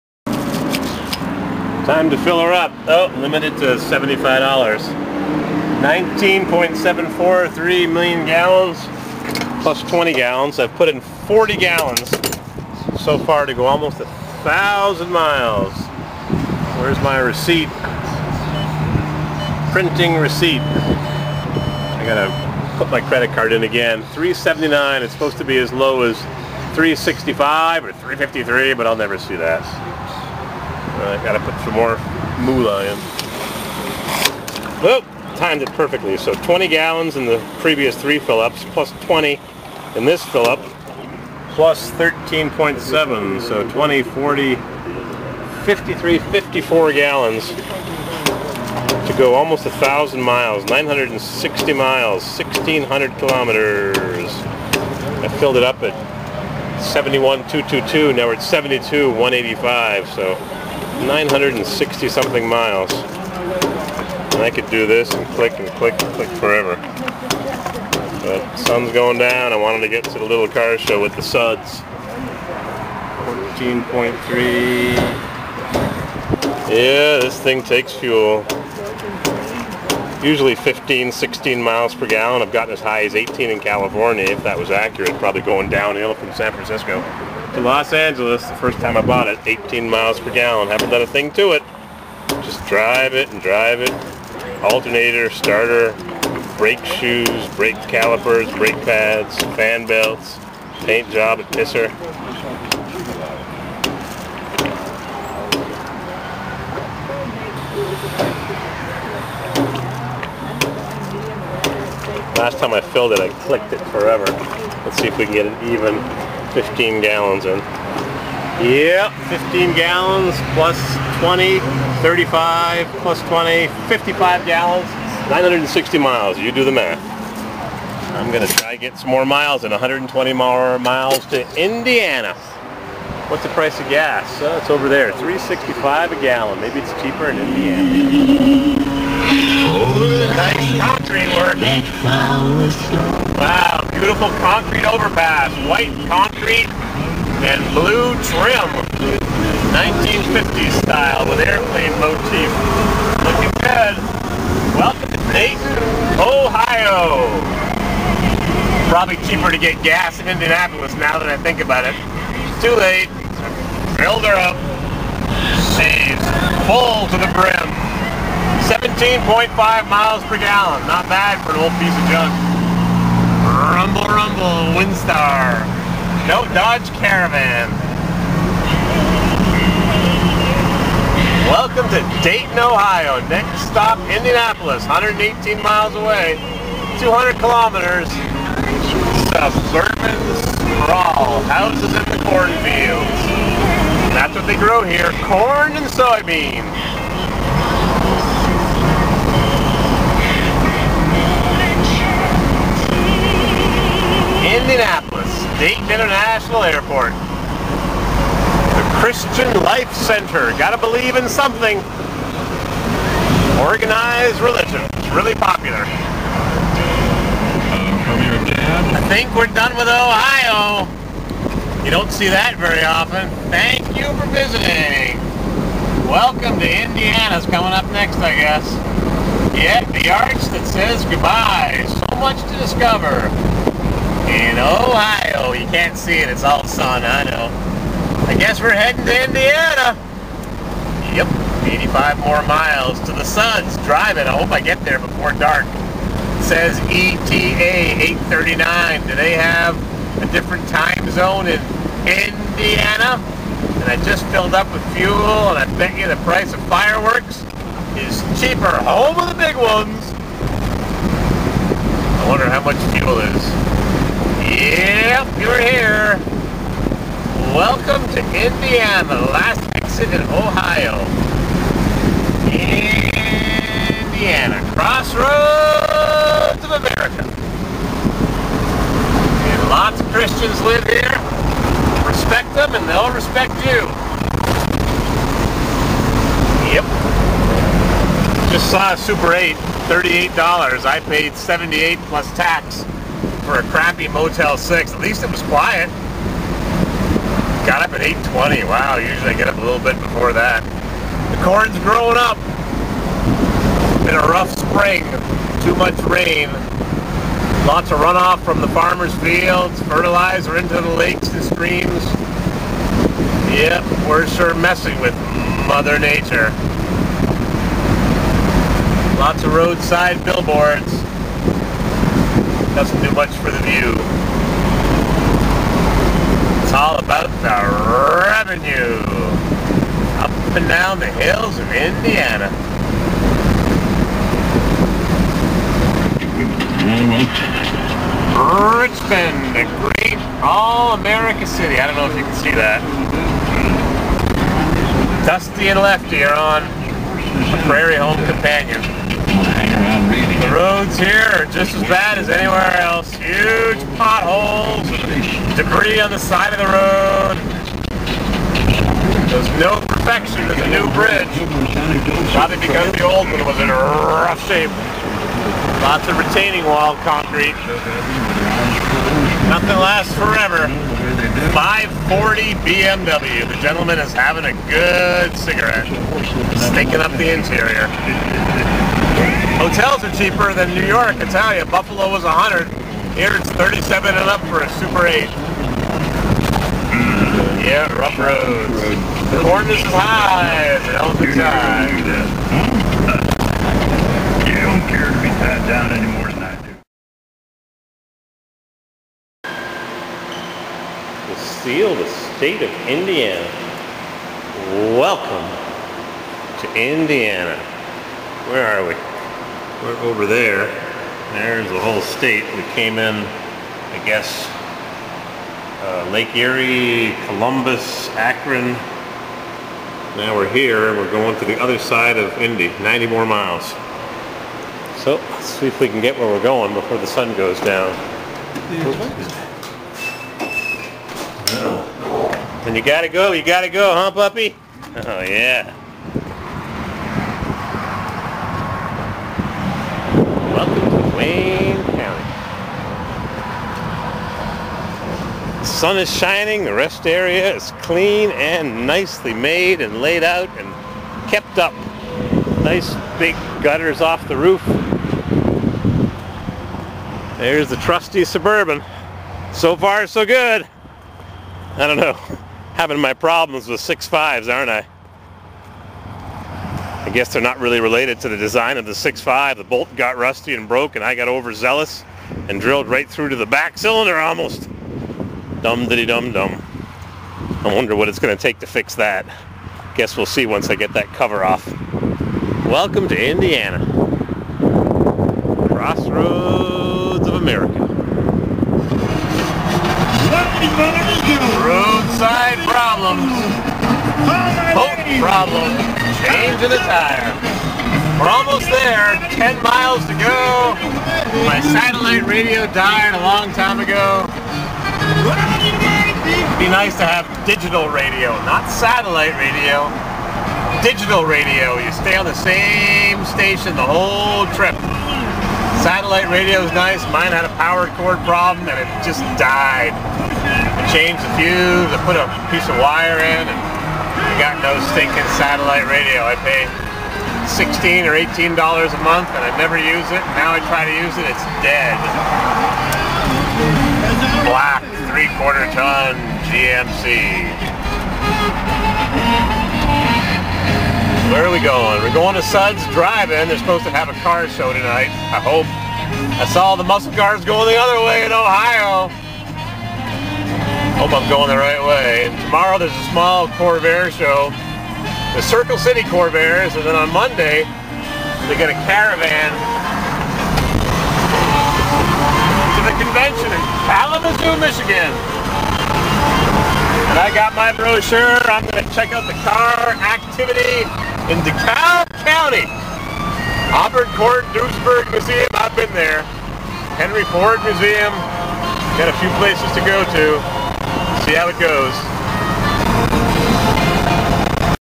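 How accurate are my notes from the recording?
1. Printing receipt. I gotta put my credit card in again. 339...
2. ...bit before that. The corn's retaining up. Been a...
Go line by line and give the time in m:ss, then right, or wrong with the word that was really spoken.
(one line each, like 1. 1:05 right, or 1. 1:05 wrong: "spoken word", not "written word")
1. 0:19 wrong: "379", not "339"
2. 4:59 wrong: "growing", not "retaining".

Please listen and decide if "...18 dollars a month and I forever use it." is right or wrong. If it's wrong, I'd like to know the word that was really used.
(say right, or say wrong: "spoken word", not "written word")
wrong: "never", not "forever".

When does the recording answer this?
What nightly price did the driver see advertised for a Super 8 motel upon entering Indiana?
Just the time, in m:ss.
4:49.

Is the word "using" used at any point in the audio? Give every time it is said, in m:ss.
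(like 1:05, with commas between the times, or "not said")
not said.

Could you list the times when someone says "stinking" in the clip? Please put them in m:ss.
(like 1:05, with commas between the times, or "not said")
6:16, 8:44.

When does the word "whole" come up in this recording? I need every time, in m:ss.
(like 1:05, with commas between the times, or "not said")
6:51, 8:33.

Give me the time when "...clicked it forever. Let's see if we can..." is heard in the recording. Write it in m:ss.
1:53.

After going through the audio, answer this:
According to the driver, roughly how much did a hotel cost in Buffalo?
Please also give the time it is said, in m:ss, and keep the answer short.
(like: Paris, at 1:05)
100, at 6:22.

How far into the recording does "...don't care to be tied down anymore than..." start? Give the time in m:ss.
6:34.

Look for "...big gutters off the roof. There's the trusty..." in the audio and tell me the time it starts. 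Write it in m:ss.
7:33.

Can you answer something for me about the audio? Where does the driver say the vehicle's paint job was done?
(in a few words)
Pisser.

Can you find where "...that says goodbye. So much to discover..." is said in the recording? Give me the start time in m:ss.
3:50.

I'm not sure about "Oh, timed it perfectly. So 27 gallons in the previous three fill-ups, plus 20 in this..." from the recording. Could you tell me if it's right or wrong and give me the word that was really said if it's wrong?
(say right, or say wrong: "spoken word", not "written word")
wrong: "20", not "27".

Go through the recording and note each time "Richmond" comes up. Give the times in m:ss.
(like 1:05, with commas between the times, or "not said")
5:38.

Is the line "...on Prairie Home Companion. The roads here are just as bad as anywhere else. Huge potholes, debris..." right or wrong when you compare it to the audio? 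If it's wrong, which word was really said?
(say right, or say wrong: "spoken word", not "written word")
right.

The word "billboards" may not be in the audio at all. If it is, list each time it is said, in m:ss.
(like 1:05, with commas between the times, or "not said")
5:20.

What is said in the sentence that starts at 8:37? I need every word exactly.
Mine had a power cord problem and it just died.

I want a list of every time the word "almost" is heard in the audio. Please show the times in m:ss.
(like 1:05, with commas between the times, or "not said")
0:13, 0:49, 7:54, 8:18.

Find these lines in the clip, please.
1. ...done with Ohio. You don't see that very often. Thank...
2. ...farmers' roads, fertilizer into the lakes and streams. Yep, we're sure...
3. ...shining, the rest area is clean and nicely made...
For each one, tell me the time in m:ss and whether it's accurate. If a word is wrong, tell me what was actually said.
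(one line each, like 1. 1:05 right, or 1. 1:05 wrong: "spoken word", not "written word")
1. 3:39 right
2. 5:08 wrong: "fields", not "roads"
3. 7:26 right.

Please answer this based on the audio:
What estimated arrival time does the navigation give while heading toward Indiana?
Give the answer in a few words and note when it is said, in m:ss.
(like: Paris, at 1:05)
8:39, at 4:08.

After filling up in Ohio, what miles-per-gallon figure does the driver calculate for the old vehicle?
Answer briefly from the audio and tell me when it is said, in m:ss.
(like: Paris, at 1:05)
17.5, at 2:48.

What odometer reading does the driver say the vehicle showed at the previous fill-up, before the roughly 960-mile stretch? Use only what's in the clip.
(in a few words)
71,222.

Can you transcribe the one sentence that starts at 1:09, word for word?
I wanted to get to the little car show with the suds.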